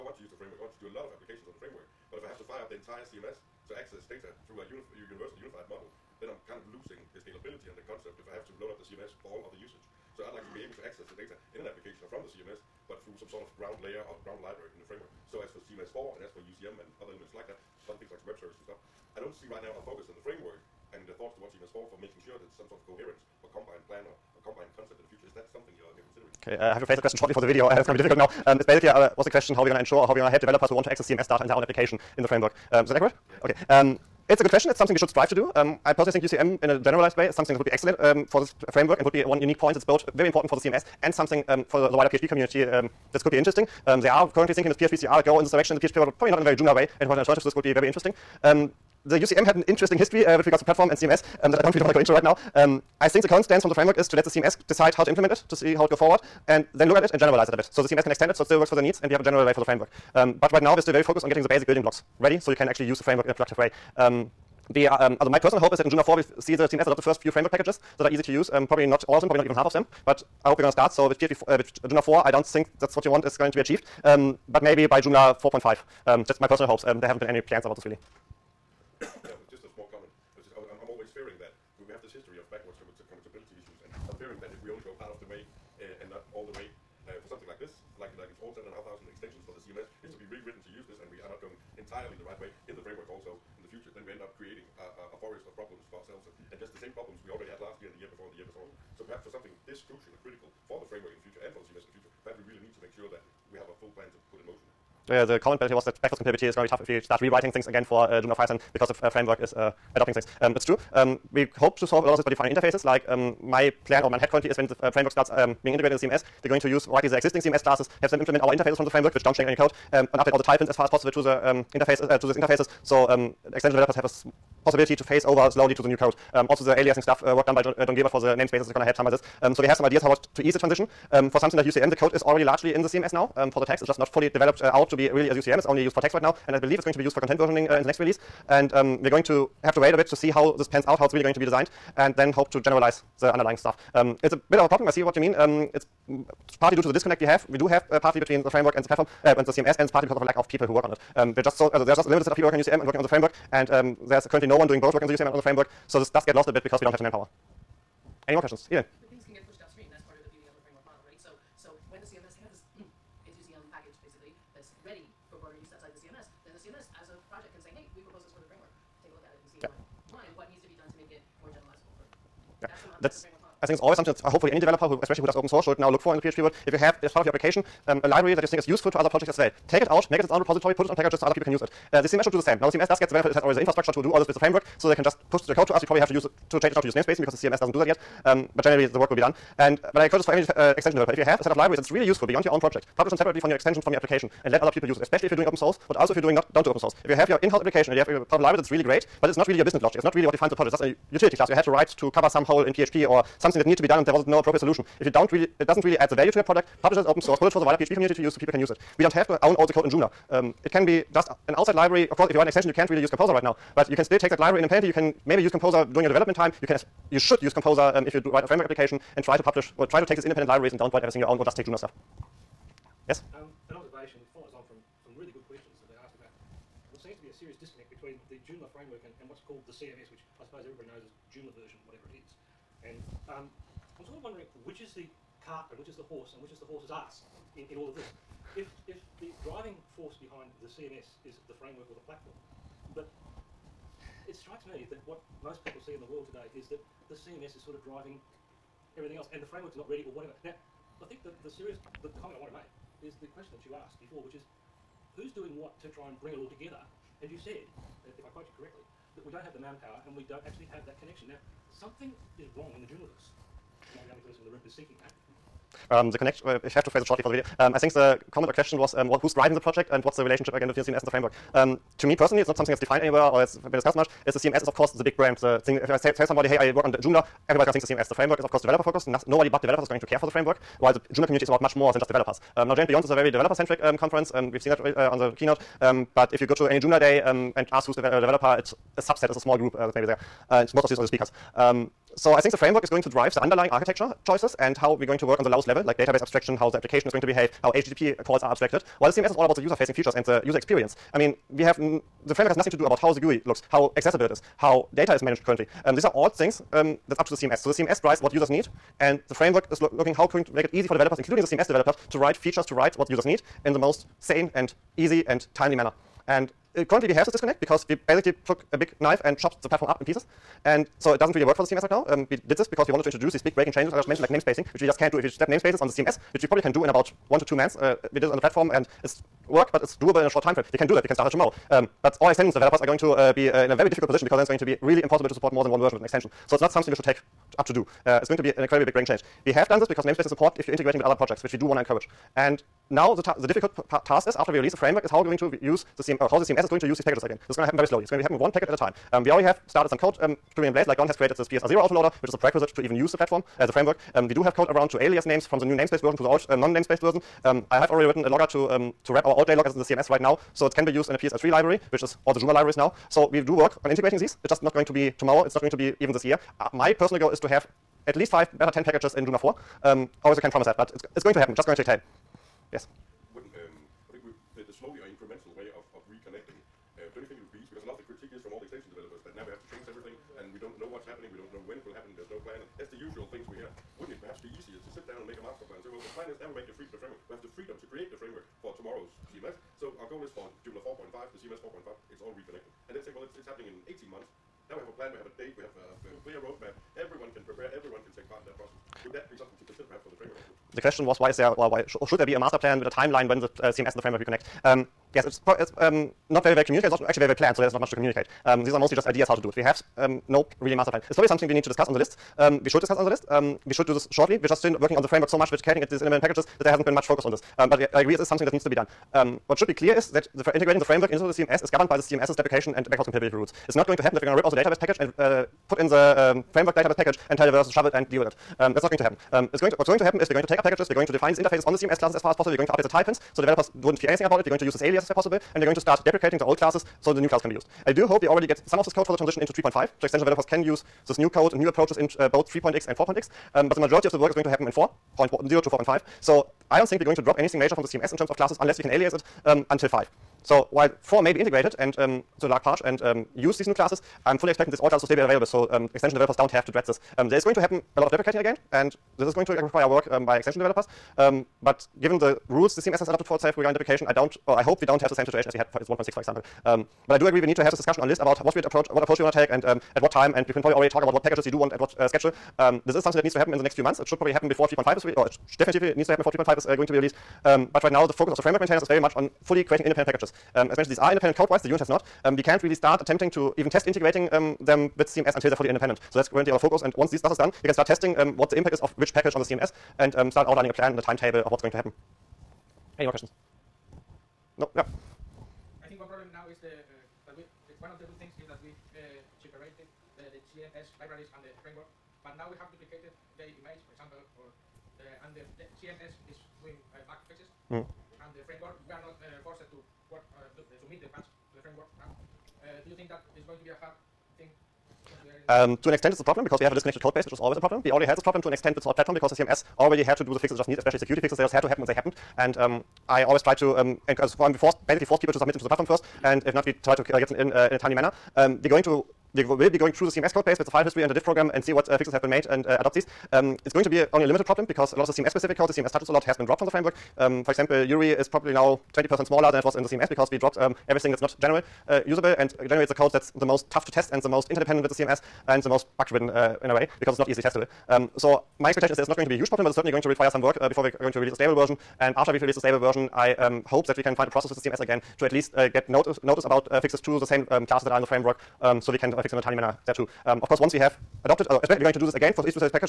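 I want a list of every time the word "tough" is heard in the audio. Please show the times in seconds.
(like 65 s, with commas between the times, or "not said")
106 s, 543 s.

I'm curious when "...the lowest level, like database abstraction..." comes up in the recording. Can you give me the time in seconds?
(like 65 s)
295 s.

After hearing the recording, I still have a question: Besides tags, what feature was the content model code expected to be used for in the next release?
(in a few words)
content versioning.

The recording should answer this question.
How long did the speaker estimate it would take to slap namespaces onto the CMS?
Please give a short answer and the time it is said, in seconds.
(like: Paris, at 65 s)
1 to 2 months, at 327 s.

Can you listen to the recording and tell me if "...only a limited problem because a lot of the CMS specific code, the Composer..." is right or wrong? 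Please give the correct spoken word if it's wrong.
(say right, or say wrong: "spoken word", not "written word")
wrong: "CMS", not "Composer".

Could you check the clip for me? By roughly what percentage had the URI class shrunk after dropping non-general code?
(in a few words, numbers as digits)
20%.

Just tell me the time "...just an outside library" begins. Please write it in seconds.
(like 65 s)
211 s.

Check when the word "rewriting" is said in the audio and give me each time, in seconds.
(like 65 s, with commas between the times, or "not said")
107 s.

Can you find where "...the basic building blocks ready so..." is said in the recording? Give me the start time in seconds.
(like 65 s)
61 s.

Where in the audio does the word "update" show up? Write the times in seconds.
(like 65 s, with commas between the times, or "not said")
120 s, 432 s.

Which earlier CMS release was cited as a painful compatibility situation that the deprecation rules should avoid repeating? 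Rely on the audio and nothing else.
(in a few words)
1.6.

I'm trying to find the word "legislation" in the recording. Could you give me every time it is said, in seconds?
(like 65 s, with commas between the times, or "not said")
not said.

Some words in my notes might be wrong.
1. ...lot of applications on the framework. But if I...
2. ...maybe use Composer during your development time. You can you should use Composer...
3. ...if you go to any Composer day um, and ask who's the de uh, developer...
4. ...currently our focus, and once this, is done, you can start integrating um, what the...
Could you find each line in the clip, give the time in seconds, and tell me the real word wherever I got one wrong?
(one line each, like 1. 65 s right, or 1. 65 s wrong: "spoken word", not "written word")
1. 0 s right
2. 215 s right
3. 286 s wrong: "Joomla", not "Composer"
4. 486 s wrong: "testing", not "integrating".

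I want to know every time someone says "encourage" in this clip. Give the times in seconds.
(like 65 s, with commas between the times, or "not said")
190 s, 341 s.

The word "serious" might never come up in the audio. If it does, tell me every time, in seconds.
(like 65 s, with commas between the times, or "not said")
227 s, 251 s.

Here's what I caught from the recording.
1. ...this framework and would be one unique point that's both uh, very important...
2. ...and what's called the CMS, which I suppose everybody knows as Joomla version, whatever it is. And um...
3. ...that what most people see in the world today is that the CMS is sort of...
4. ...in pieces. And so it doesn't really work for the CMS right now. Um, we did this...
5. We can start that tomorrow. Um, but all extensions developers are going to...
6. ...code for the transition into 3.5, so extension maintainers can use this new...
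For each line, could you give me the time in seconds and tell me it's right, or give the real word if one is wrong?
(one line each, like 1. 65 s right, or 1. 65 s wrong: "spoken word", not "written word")
1. 38 s right
2. 229 s right
3. 244 s right
4. 320 s right
5. 331 s right
6. 438 s wrong: "developers", not "maintainers".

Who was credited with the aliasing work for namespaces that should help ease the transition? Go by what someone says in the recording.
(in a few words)
Don Gilbert.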